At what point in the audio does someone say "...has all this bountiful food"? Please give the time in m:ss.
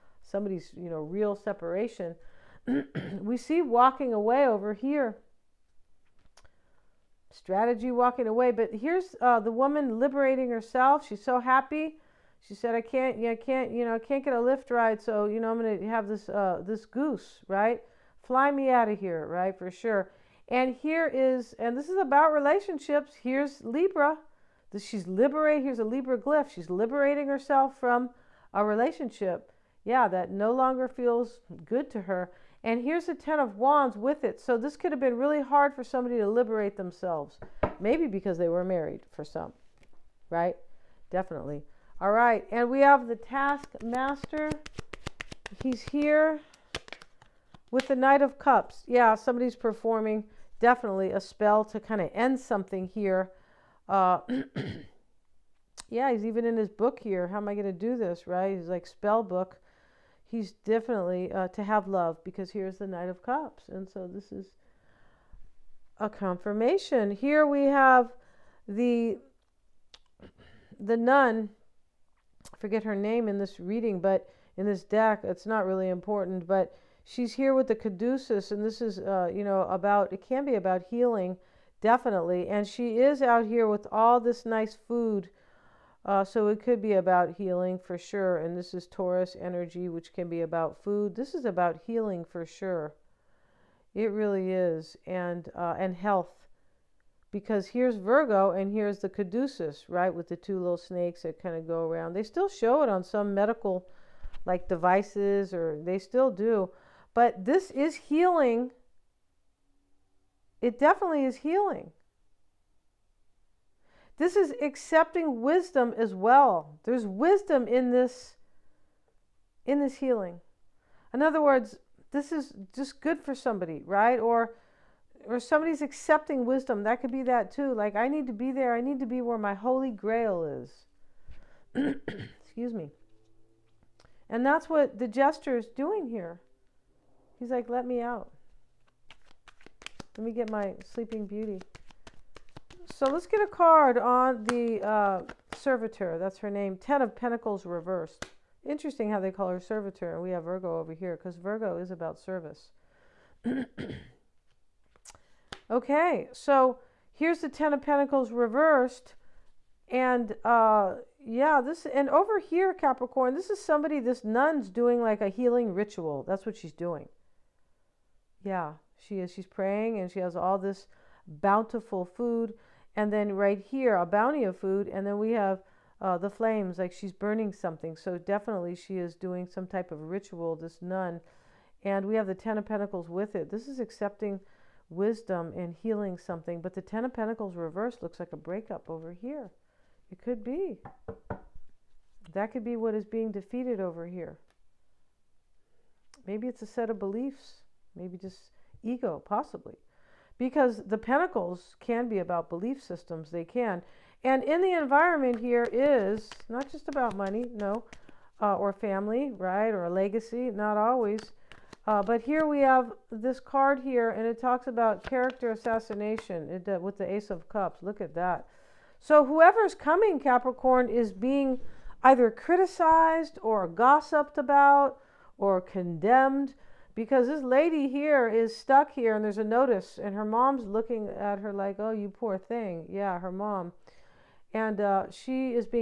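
2:50.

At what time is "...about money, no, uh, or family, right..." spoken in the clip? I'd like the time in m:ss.
3:26.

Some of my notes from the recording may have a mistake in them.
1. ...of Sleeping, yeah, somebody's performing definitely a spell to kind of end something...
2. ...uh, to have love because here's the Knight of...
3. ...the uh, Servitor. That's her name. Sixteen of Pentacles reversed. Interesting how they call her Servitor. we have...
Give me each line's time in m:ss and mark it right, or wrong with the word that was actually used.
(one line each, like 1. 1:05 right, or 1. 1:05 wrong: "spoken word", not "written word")
1. 0:48 wrong: "Cups", not "Sleeping"
2. 1:01 right
3. 2:24 wrong: "Ten", not "Sixteen".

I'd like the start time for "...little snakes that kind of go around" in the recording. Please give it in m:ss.
1:40.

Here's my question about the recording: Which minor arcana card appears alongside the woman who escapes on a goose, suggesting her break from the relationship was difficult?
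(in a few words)
Ten of Wands.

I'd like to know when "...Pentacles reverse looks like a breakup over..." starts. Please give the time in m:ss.
3:07.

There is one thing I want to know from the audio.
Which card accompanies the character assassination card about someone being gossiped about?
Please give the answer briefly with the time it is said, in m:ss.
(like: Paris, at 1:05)
Ace of Cups, at 3:37.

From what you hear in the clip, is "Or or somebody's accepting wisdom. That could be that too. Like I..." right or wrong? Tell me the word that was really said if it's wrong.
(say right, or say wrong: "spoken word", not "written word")
right.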